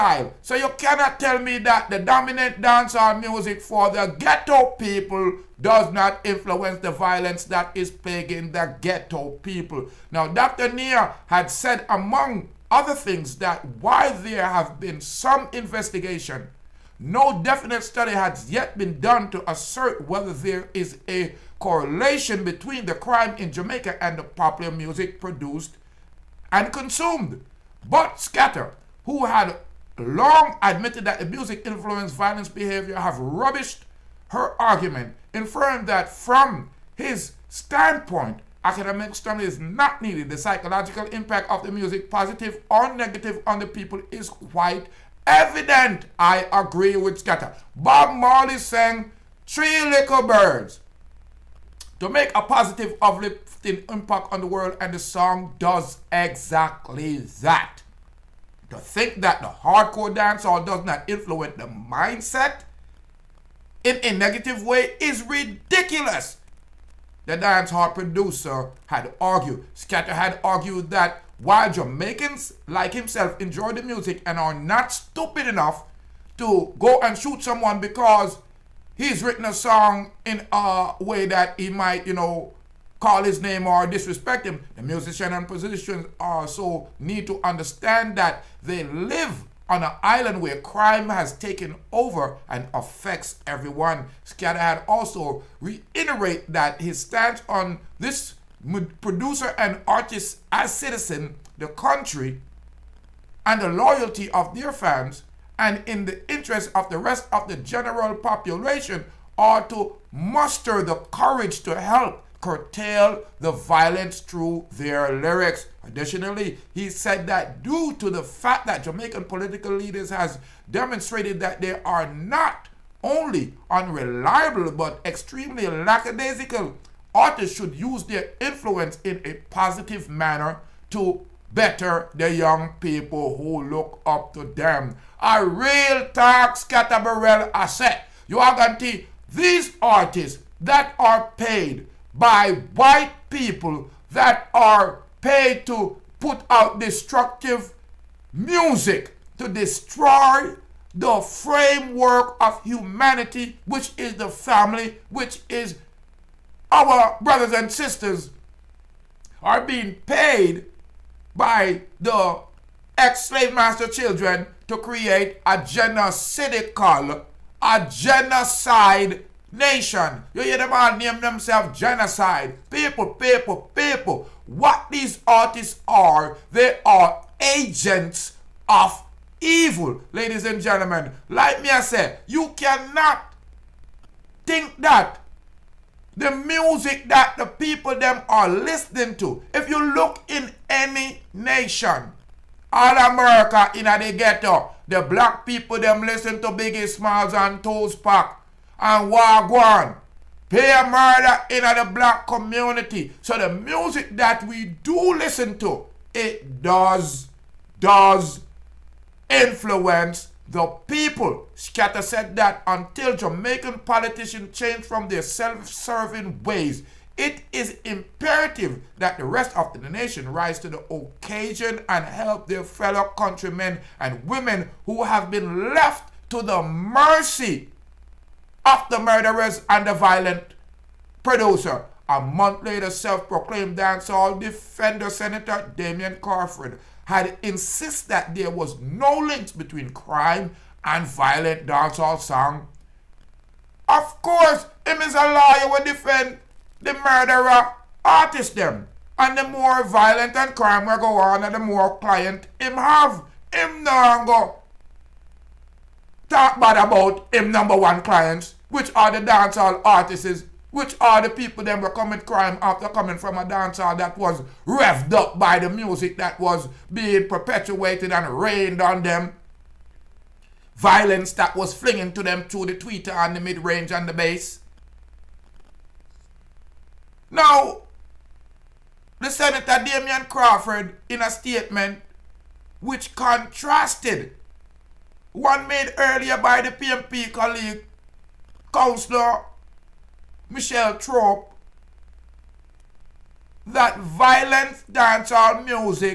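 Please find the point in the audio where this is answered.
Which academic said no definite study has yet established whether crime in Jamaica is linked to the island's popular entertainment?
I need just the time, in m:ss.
0:10.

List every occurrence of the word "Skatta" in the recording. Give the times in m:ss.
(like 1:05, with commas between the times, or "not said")
0:28, 0:47, 1:09, 2:16, 3:31.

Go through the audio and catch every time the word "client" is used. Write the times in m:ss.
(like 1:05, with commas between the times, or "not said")
4:11, 4:18.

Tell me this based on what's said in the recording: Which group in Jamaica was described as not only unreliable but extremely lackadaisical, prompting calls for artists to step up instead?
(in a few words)
political leaders.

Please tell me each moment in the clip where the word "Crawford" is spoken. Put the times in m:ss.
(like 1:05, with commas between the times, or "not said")
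3:56, 4:40.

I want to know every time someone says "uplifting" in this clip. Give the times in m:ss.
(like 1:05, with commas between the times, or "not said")
0:53.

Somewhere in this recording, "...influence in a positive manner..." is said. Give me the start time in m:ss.
2:08.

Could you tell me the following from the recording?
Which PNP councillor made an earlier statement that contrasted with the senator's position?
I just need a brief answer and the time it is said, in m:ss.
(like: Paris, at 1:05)
Michel Troupe, at 4:50.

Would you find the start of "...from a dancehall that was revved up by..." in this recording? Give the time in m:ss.
4:23.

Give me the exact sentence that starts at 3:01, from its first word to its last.
Like me, I said, you cannot think that the music that the people them are listening to.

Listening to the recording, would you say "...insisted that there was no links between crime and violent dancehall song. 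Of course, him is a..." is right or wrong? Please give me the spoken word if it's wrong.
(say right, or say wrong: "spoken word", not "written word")
right.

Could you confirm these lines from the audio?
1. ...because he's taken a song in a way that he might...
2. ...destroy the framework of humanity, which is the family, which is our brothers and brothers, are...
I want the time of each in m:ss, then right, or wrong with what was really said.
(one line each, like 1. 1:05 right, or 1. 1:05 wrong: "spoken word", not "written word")
1. 1:17 wrong: "written", not "taken"
2. 2:29 wrong: "sisters", not "brothers".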